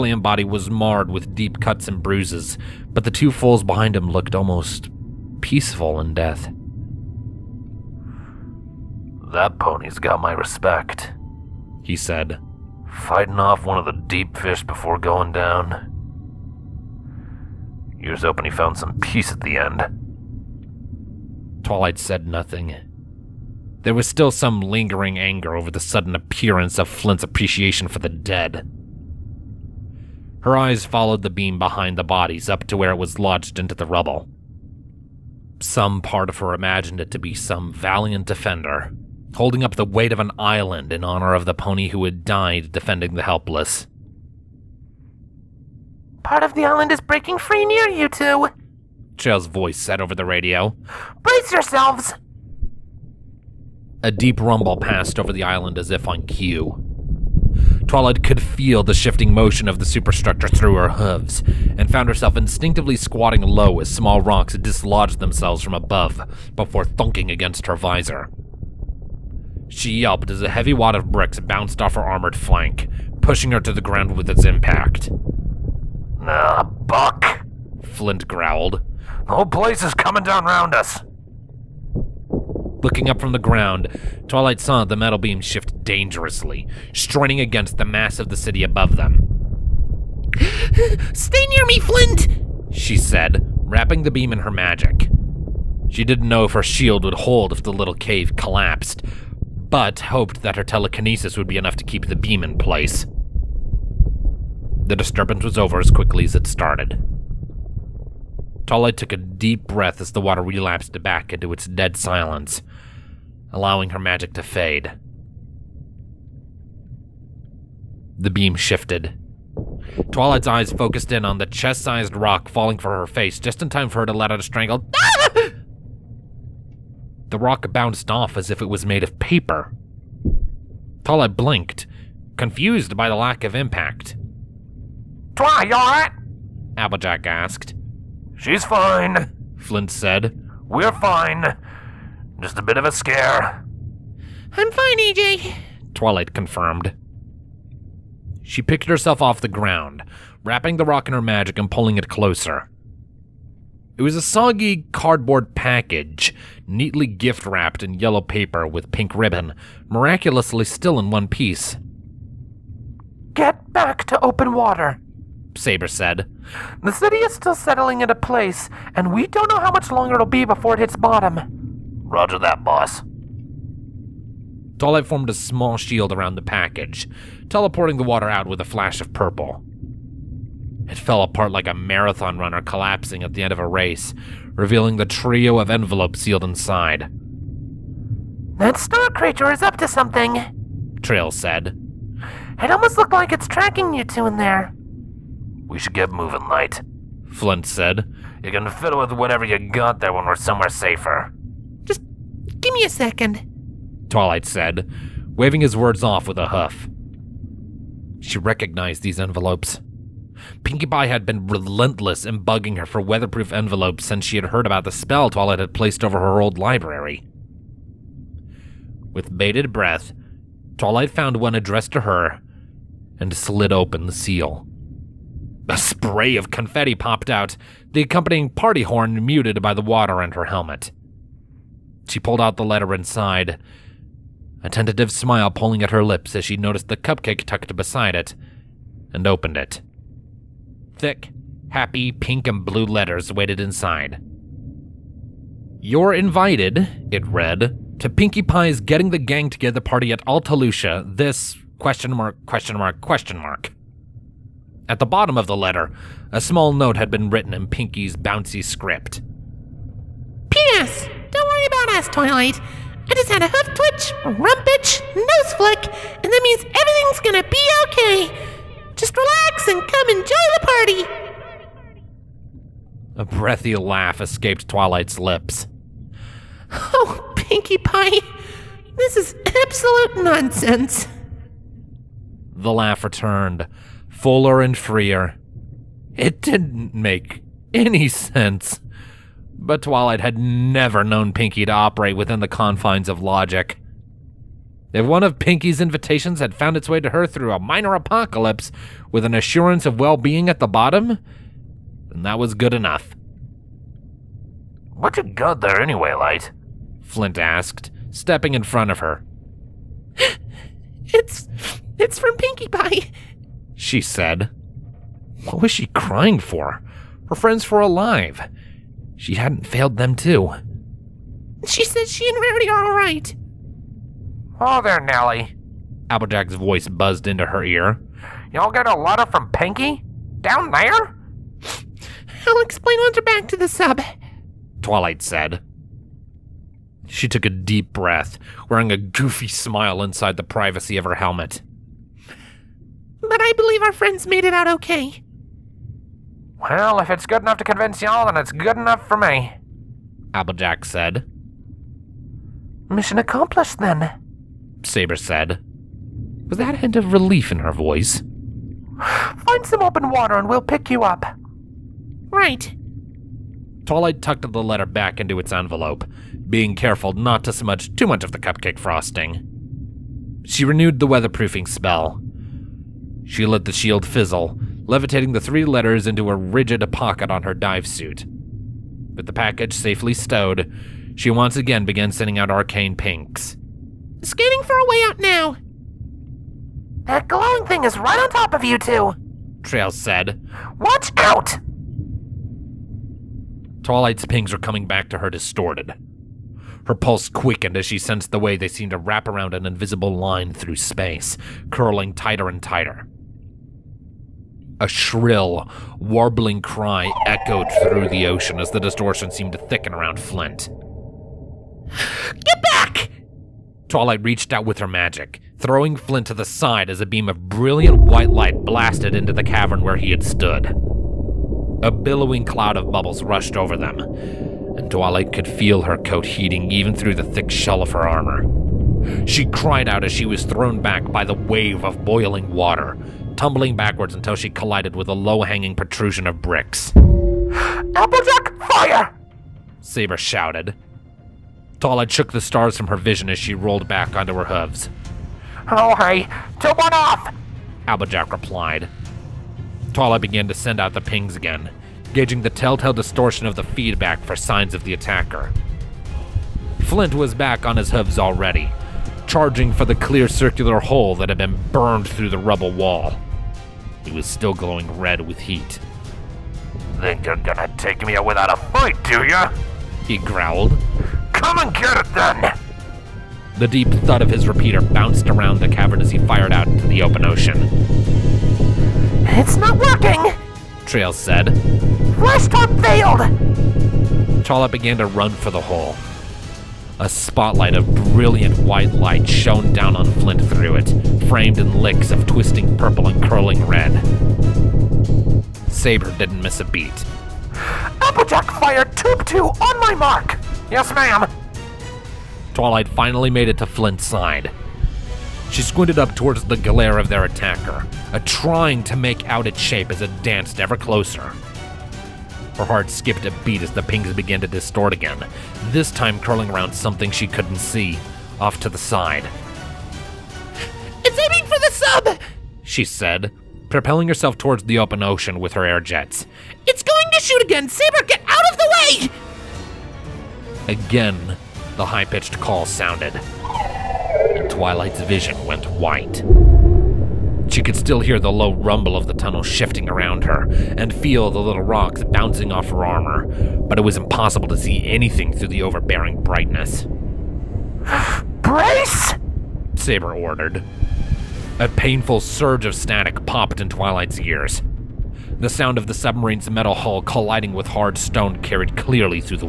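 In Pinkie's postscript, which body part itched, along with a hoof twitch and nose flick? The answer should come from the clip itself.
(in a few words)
Rump.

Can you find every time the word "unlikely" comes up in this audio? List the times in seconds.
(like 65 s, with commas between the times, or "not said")
not said.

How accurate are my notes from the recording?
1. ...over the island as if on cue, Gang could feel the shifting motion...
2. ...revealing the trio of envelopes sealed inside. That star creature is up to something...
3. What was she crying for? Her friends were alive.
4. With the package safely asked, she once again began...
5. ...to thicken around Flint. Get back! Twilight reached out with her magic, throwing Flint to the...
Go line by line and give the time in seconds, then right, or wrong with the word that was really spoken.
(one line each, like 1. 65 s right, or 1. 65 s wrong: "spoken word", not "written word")
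1. 55 s wrong: "Twilight", not "Gang"
2. 184 s right
3. 315 s right
4. 379 s wrong: "stowed", not "asked"
5. 409 s right.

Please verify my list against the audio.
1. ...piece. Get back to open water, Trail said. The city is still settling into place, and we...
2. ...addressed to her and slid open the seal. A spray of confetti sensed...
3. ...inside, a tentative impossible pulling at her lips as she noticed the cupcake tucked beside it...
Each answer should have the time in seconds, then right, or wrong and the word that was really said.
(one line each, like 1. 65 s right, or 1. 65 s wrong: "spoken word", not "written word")
1. 161 s wrong: "Saber", not "Trail"
2. 221 s wrong: "popped", not "sensed"
3. 232 s wrong: "smile", not "impossible".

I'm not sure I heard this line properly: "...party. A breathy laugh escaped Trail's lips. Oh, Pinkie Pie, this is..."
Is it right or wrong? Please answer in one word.
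wrong.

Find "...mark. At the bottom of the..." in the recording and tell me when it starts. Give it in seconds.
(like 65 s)
253 s.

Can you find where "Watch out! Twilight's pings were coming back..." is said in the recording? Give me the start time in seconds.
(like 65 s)
390 s.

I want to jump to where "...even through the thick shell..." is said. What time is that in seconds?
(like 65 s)
426 s.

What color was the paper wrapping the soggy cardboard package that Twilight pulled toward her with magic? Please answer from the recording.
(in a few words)
Yellow.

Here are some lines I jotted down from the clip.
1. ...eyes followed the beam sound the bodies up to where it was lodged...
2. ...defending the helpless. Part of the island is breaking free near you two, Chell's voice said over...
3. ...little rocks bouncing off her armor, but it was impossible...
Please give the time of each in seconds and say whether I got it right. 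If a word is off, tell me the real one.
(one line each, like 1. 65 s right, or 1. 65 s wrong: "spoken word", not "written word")
1. 30 s wrong: "behind", not "sound"
2. 42 s right
3. 541 s right.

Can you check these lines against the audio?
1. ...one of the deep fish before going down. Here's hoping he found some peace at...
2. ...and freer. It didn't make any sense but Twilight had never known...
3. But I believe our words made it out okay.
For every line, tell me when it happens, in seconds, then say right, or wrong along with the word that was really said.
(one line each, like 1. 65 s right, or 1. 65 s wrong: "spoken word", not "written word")
1. 13 s right
2. 284 s right
3. 343 s wrong: "friends", not "words".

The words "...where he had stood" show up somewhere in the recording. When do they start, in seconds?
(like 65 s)
419 s.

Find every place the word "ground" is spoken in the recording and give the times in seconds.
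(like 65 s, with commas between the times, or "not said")
73 s, 83 s, 149 s.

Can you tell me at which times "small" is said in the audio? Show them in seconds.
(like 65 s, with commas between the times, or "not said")
63 s, 175 s, 256 s.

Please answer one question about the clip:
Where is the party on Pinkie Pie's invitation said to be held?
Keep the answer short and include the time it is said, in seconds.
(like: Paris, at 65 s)
Altalucia, at 250 s.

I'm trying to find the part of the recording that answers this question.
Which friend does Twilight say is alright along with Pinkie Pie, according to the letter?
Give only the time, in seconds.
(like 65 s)
322 s.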